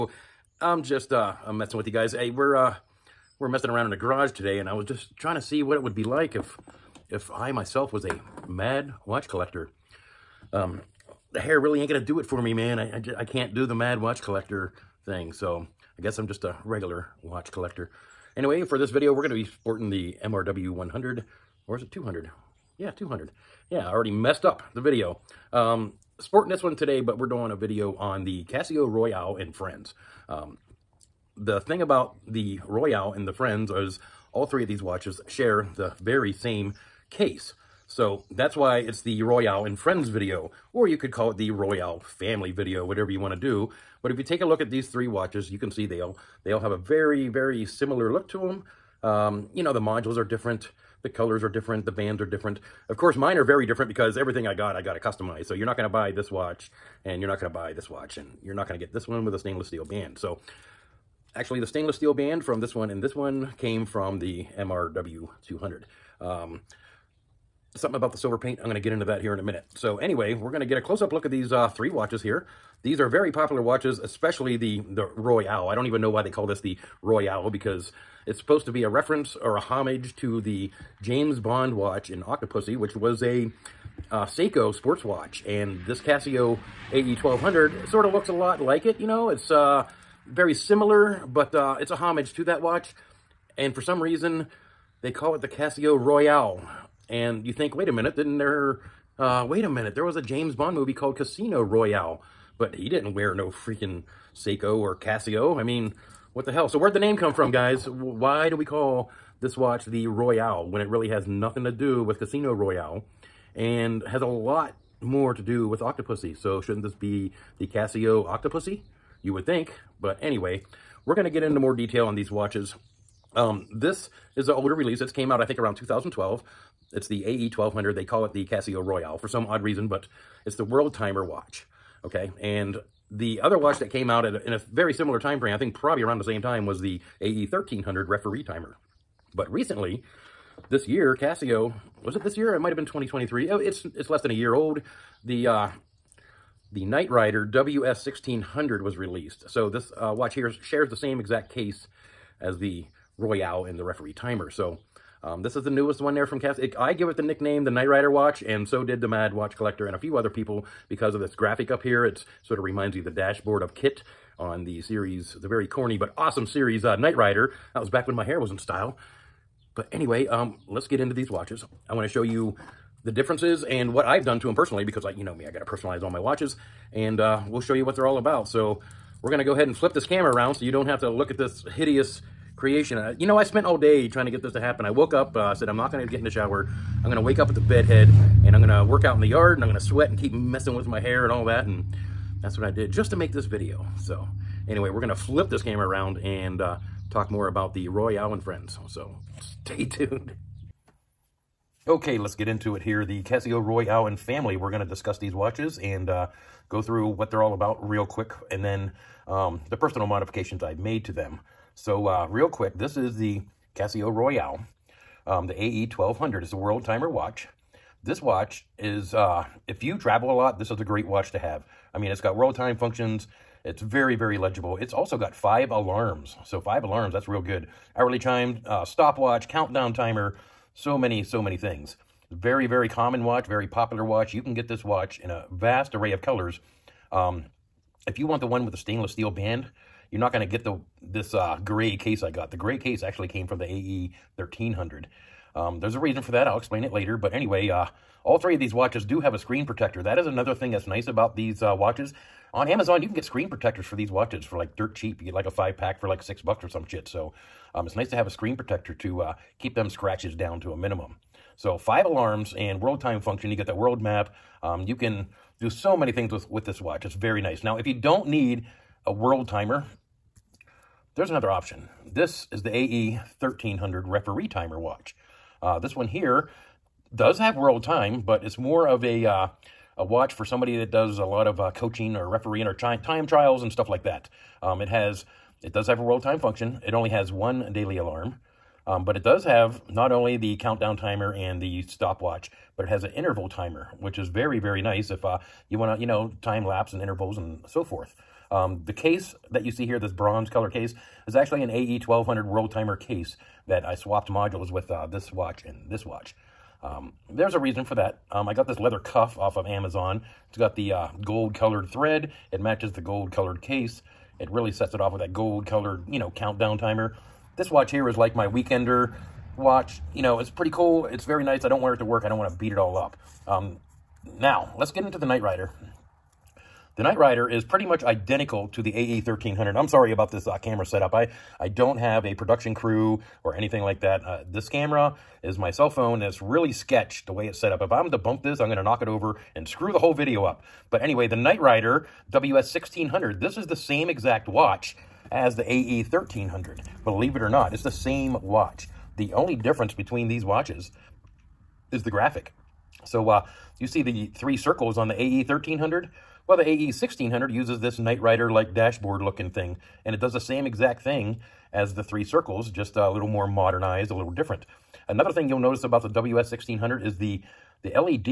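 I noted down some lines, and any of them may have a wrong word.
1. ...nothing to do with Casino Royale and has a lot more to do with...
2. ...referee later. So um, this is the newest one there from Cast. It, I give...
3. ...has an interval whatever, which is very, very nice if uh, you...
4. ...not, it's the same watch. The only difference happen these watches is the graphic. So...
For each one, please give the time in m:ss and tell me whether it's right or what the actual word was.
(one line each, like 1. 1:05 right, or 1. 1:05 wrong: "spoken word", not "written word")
1. 1:51 right
2. 2:33 wrong: "timer", not "later"
3. 4:52 wrong: "timer", not "whatever"
4. 5:47 wrong: "between", not "happen".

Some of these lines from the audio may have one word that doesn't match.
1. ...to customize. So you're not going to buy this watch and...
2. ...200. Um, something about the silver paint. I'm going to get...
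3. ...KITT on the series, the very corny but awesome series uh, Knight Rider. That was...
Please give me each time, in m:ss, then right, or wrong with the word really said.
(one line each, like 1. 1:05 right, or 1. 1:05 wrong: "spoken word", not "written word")
1. 0:54 right
2. 1:05 right
3. 2:43 right.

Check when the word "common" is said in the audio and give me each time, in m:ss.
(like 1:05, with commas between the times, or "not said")
3:52.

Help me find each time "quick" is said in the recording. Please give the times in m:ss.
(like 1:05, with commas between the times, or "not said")
3:28, 3:32.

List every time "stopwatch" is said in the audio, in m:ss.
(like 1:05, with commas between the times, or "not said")
3:48, 4:51.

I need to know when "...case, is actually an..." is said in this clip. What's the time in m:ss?
5:00.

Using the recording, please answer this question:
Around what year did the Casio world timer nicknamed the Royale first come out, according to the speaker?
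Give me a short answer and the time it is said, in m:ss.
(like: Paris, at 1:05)
2012, at 2:05.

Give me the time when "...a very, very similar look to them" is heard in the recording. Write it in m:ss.
0:46.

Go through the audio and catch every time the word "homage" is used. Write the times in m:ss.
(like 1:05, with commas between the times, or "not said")
1:19, 1:31.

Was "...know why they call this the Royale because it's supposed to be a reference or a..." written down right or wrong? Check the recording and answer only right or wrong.
right.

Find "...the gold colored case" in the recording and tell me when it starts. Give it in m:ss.
5:12.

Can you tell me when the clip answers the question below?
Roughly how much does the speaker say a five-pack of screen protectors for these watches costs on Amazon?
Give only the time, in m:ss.
4:16.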